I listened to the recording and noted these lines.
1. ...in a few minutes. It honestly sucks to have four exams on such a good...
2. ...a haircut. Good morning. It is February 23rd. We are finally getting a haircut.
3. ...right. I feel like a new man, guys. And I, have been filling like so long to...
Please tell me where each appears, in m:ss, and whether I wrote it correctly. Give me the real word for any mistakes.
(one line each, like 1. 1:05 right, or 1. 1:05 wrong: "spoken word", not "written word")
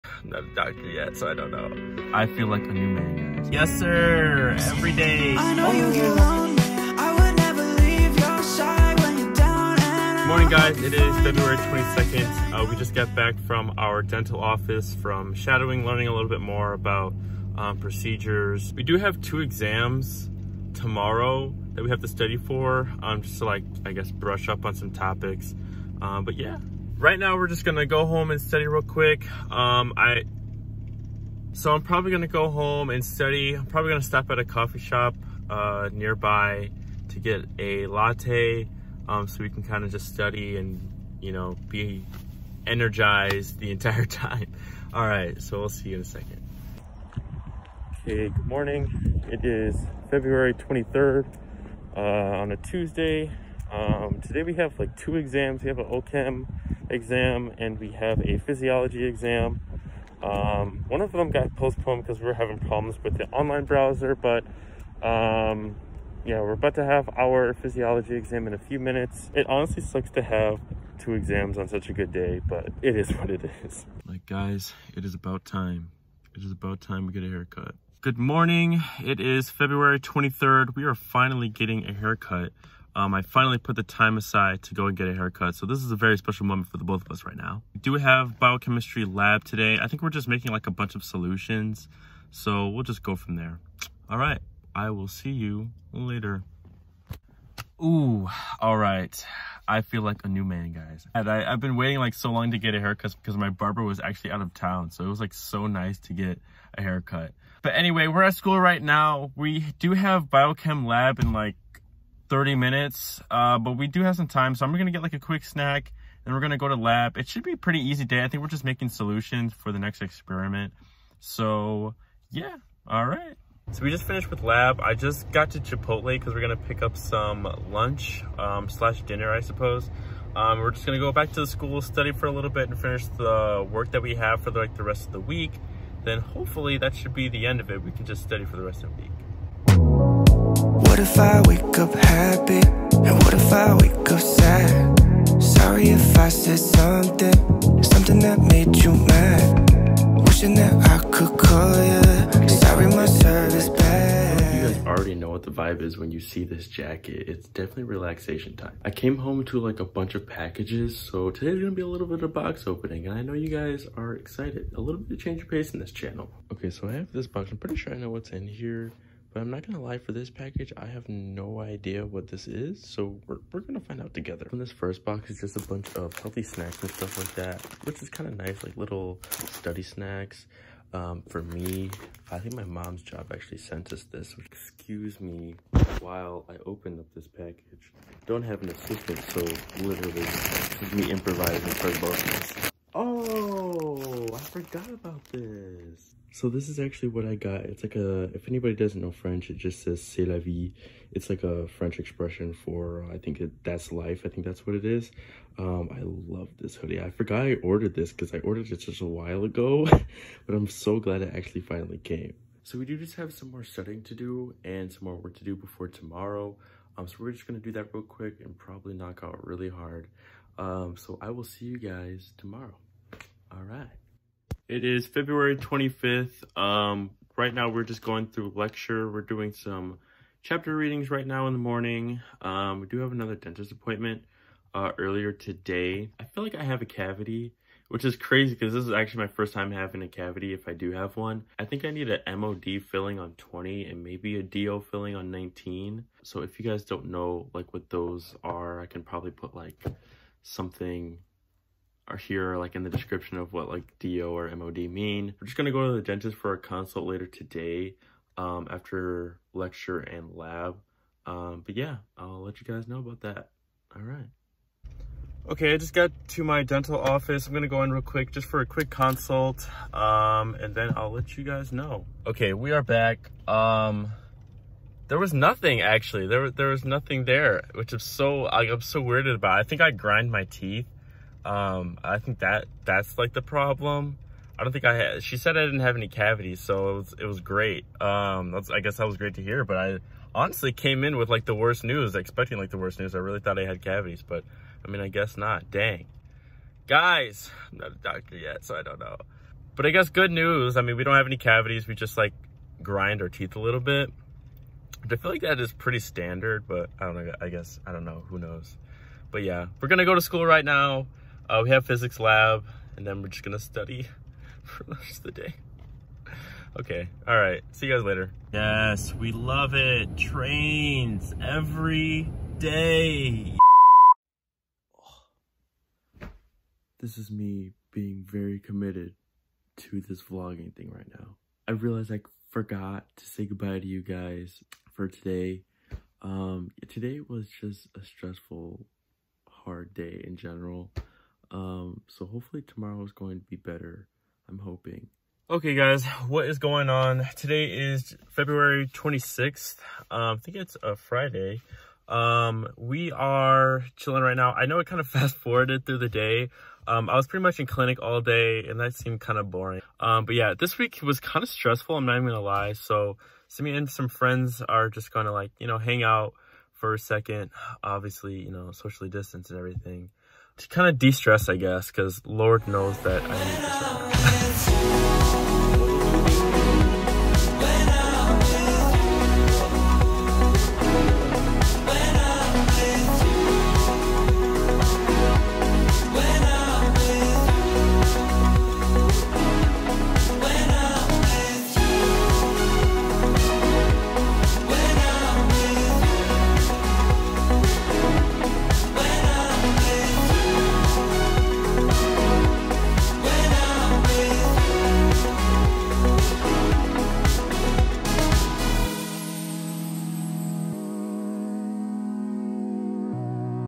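1. 1:08 wrong: "two", not "four"
2. 1:17 right
3. 1:38 wrong: "waiting", not "filling".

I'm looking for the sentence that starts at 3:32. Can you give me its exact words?
So we do just have some more studying to do and some more work to do before tomorrow.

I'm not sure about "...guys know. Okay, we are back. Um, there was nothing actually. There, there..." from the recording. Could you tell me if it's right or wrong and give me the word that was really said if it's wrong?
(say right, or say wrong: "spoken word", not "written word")
right.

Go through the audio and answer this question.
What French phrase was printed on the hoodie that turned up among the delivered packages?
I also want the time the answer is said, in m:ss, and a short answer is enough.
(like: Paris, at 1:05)
c'est la vie, at 3:20.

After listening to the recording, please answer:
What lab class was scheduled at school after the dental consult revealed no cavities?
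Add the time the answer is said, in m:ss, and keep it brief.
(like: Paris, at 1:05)
physics lab, at 5:11.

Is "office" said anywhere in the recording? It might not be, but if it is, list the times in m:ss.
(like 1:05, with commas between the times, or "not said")
0:14, 4:26.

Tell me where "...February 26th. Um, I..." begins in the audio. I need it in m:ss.
5:48.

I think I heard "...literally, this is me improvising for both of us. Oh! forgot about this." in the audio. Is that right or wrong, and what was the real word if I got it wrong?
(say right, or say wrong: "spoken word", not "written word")
right.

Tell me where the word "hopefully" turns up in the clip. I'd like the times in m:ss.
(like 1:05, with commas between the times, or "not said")
2:16, 5:42.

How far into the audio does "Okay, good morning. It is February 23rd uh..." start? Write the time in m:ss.
0:48.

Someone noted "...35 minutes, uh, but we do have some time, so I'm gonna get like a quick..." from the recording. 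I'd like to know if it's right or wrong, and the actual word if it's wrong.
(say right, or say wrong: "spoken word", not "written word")
wrong: "30", not "35".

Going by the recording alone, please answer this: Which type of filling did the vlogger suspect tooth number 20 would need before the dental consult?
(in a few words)
MOD filling.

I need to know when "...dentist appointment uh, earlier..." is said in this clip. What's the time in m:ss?
3:53.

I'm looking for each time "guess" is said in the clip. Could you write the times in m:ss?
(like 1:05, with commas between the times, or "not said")
0:23, 4:48, 4:55, 4:59, 5:07, 6:11.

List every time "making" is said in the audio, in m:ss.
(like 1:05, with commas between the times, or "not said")
1:30, 1:58.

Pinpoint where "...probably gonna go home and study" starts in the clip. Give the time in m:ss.
0:31.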